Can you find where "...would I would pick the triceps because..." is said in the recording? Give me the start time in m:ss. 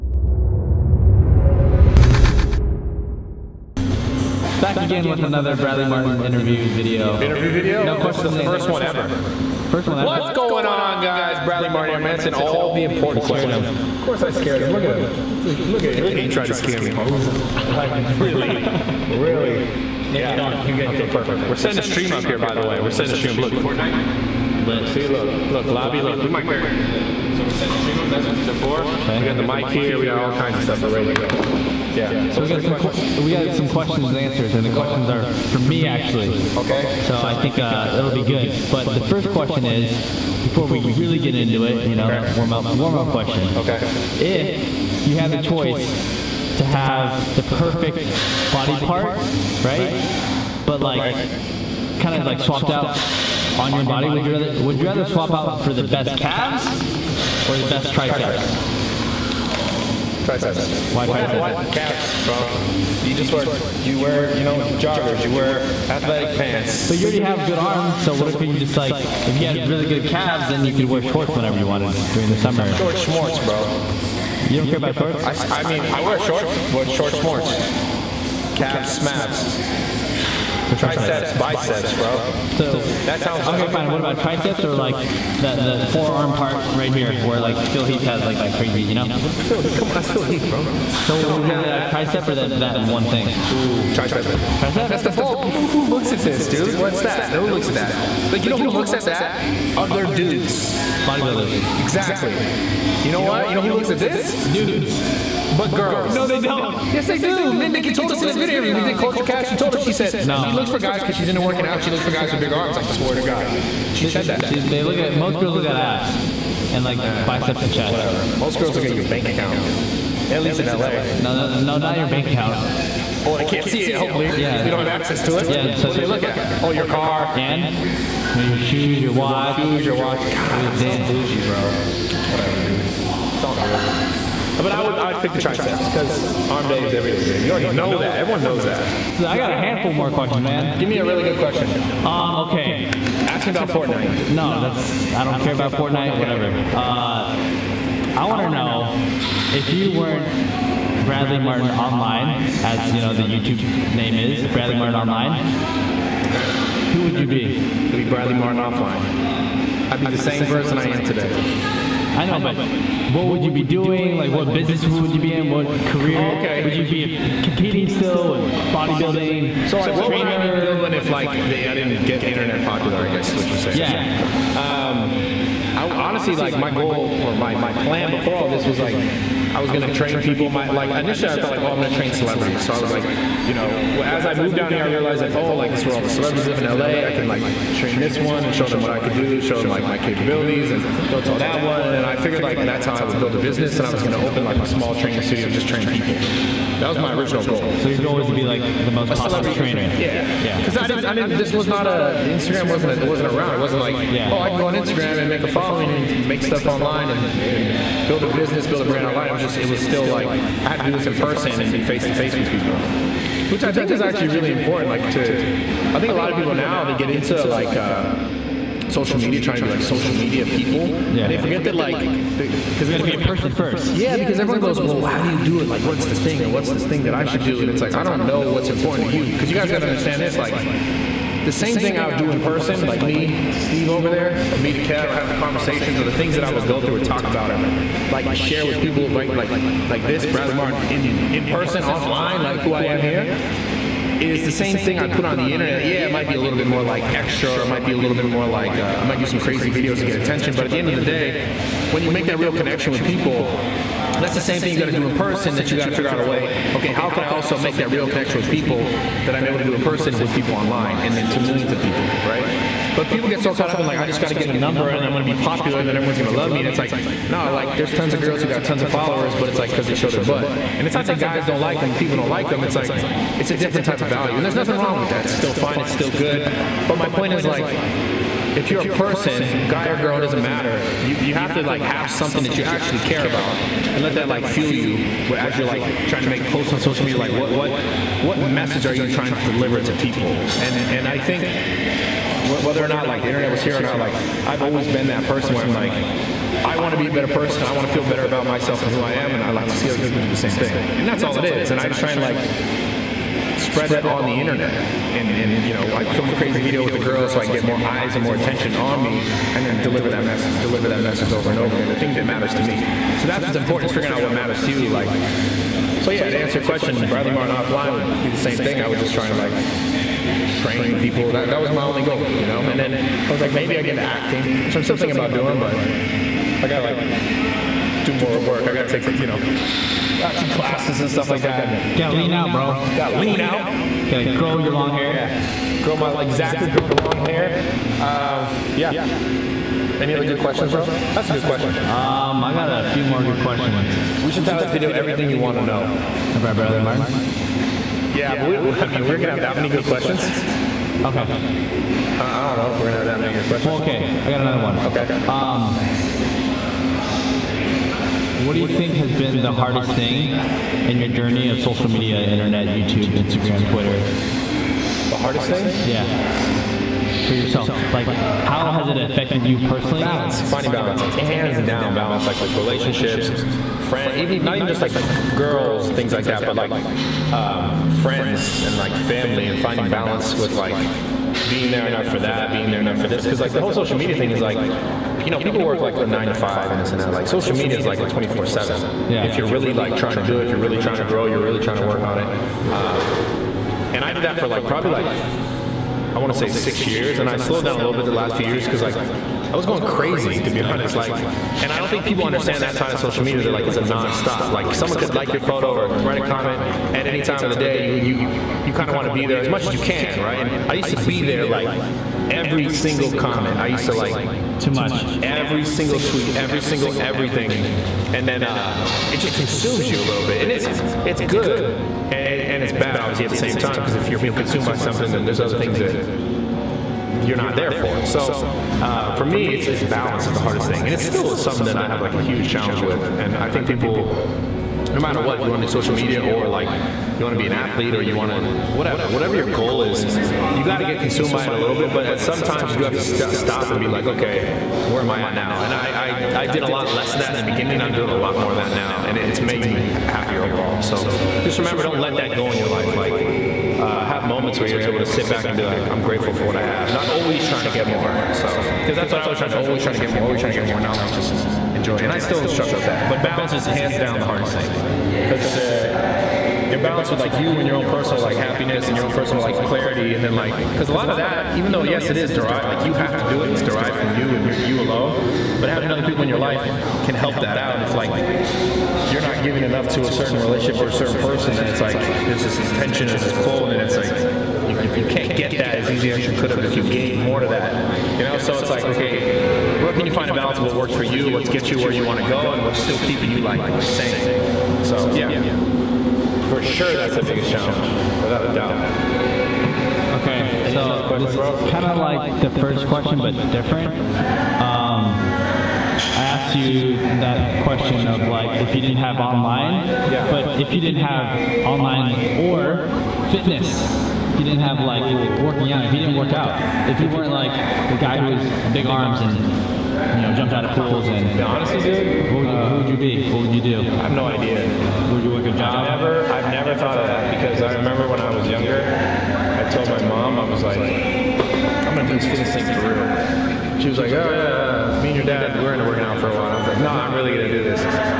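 2:14.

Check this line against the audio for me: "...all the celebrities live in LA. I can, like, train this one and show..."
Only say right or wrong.
right.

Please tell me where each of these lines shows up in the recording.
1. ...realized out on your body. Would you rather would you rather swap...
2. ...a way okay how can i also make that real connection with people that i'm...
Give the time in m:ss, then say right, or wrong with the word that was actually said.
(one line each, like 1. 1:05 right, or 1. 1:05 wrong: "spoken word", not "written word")
1. 0:52 wrong: "swapped", not "realized"
2. 4:16 right.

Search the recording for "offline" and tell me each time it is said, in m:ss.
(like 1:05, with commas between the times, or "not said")
2:38, 4:01, 5:17.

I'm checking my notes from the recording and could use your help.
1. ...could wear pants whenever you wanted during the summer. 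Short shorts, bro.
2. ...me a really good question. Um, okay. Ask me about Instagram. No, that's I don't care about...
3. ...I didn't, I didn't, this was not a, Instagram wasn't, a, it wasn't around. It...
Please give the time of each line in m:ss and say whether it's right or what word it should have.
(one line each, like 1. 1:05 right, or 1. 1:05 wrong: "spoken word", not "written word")
1. 1:10 wrong: "shorts", not "pants"
2. 2:20 wrong: "Fortnite", not "Instagram"
3. 3:20 right.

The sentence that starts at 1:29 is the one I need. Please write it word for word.
Phil, Heath, come on, that's Phil Heath, bro.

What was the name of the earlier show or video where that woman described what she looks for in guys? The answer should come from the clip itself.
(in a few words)
Culture Cast.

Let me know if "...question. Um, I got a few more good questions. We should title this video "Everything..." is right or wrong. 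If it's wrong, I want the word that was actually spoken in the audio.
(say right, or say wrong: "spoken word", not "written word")
right.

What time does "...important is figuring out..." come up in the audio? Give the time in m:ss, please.
5:13.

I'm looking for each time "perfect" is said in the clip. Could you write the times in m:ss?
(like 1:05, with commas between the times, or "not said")
0:21, 0:47.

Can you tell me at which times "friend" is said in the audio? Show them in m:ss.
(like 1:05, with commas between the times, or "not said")
6:13, 6:18.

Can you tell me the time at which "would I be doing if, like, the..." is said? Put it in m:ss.
2:50.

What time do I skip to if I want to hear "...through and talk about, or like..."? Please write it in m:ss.
3:56.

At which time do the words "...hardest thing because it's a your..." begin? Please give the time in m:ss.
7:44.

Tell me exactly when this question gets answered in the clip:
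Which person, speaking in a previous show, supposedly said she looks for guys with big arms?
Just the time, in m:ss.
1:47.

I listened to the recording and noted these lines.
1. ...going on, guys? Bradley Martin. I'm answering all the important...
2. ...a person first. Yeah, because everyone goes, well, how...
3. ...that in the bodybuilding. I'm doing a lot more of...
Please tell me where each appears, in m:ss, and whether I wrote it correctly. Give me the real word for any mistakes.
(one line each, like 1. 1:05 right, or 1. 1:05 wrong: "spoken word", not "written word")
1. 0:10 right
2. 3:43 right
3. 7:27 wrong: "beginning", not "bodybuilding".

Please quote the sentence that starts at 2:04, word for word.
So they don't have access to it.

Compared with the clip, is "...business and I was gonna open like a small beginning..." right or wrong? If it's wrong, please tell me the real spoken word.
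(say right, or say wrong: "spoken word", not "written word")
wrong: "training", not "beginning".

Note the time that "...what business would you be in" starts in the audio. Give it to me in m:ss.
2:44.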